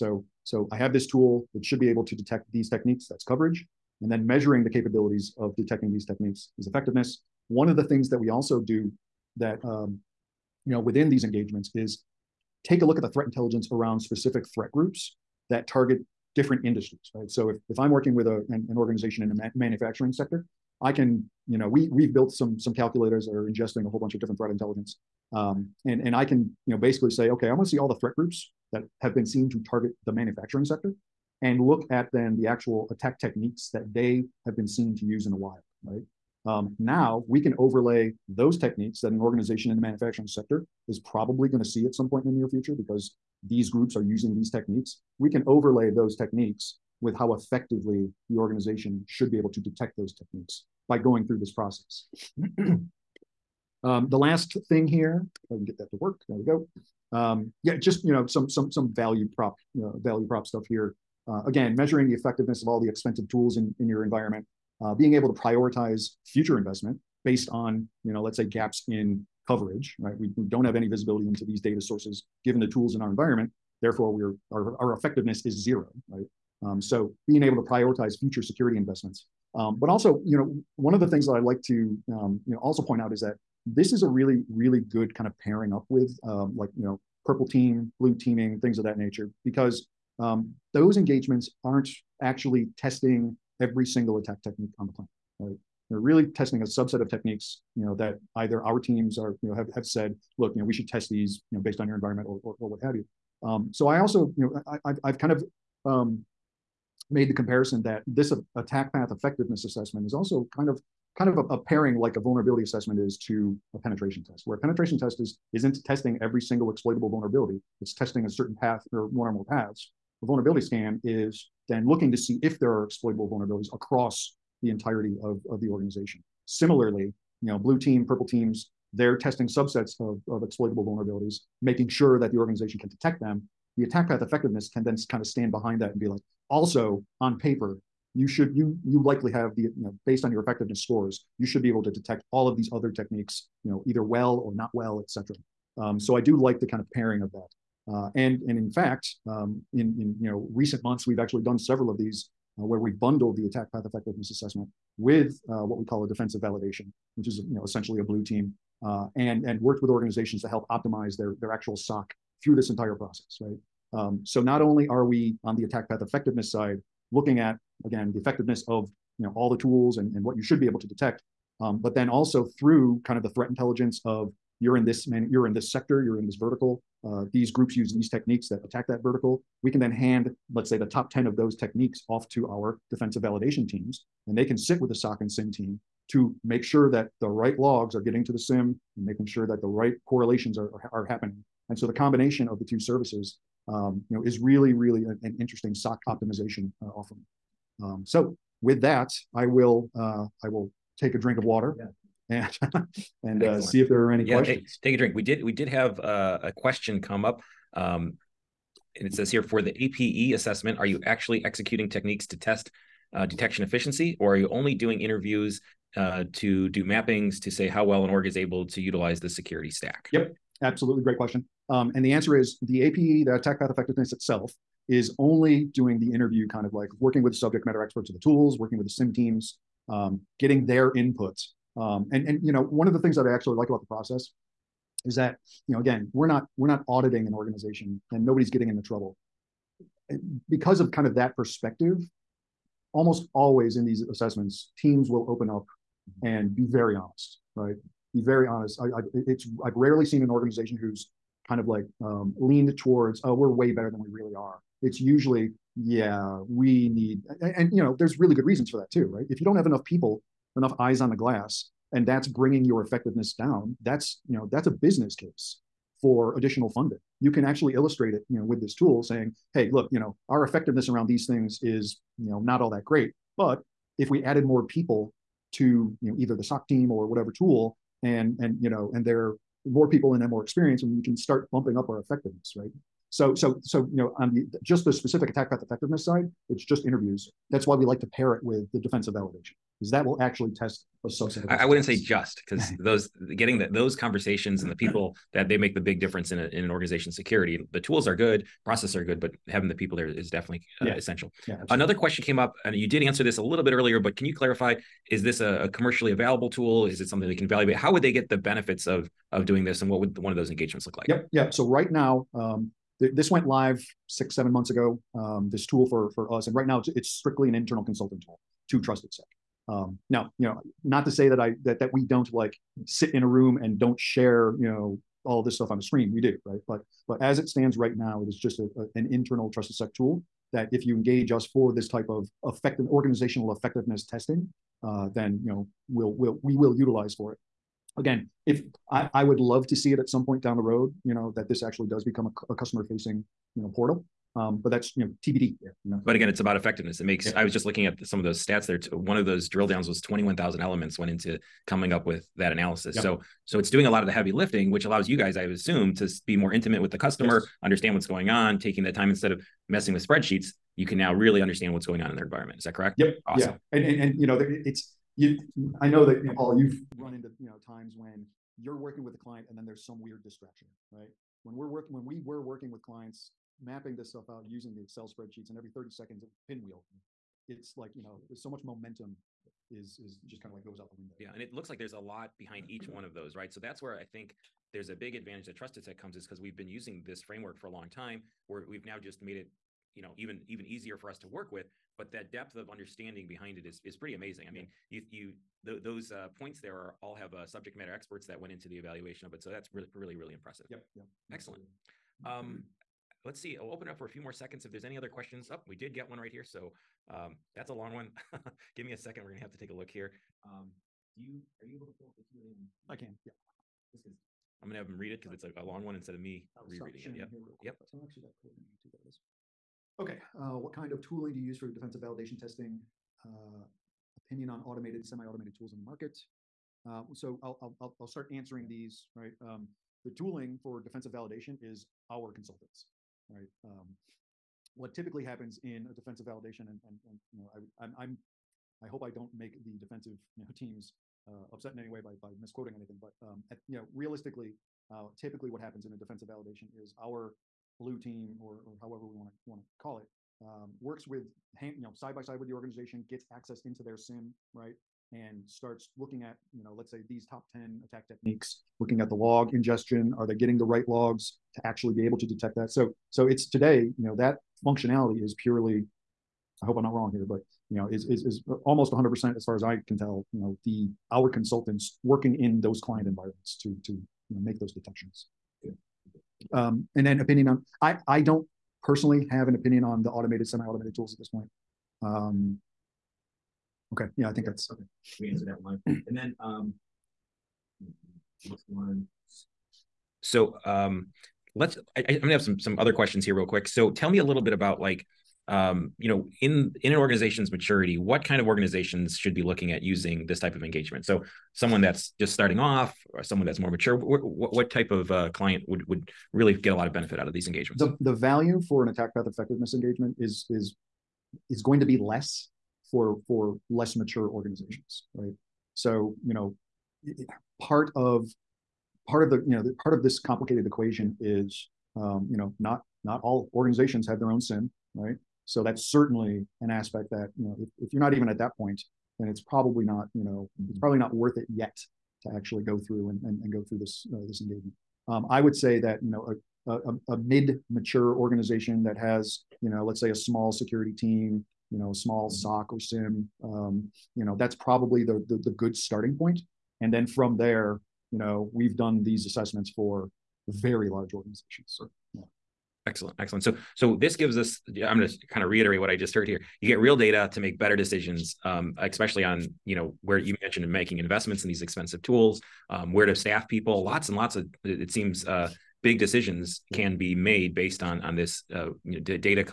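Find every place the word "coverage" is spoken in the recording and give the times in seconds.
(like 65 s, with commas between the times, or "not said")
3 s, 69 s.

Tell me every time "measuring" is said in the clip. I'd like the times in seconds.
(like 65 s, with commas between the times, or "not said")
4 s, 61 s.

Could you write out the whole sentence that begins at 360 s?
You can now really understand what's going on in their environment.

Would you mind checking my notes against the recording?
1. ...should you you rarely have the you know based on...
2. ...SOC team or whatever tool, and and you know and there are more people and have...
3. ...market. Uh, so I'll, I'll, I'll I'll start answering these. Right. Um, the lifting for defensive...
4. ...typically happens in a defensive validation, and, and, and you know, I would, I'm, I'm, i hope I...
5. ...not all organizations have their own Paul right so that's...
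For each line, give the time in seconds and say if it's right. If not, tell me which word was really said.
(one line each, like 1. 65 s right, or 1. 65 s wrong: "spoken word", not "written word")
1. 138 s wrong: "likely", not "rarely"
2. 276 s right
3. 425 s wrong: "tooling", not "lifting"
4. 434 s right
5. 523 s wrong: "SIEM", not "Paul".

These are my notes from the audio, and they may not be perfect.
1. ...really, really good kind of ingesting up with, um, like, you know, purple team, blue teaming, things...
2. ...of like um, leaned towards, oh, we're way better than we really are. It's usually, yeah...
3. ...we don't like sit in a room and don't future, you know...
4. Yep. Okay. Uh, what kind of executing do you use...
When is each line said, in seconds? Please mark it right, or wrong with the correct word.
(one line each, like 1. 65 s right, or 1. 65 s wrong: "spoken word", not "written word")
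1. 84 s wrong: "pairing", not "ingesting"
2. 251 s right
3. 321 s wrong: "share", not "future"
4. 417 s wrong: "tooling", not "executing".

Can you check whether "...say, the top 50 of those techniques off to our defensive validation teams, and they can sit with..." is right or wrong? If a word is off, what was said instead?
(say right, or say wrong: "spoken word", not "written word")
wrong: "10", not "50".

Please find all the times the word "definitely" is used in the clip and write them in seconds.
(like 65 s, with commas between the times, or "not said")
300 s.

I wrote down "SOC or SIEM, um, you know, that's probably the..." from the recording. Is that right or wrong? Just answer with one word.
right.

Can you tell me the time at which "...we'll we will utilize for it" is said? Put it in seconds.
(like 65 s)
336 s.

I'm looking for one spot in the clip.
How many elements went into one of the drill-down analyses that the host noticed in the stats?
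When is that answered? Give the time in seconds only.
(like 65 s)
350 s.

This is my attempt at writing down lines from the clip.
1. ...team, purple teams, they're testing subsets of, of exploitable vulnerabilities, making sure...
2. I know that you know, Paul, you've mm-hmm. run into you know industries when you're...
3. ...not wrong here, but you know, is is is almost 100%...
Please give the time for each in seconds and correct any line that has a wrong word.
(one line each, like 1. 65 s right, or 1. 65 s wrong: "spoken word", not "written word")
1. 127 s right
2. 365 s wrong: "times", not "industries"
3. 466 s right.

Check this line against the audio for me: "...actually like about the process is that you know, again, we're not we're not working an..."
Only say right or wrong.
wrong.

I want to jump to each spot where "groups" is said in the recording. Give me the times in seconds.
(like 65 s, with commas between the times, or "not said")
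14 s, 28 s, 43 s, 177 s.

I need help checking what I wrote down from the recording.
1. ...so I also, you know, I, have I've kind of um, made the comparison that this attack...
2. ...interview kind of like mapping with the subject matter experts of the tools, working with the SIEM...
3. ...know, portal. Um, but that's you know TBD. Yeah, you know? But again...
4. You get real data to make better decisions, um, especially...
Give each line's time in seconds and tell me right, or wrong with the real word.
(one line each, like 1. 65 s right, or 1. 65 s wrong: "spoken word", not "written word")
1. 103 s right
2. 226 s wrong: "working", not "mapping"
3. 343 s right
4. 556 s right.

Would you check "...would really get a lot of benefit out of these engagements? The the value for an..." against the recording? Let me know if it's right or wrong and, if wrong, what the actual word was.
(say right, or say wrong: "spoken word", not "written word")
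right.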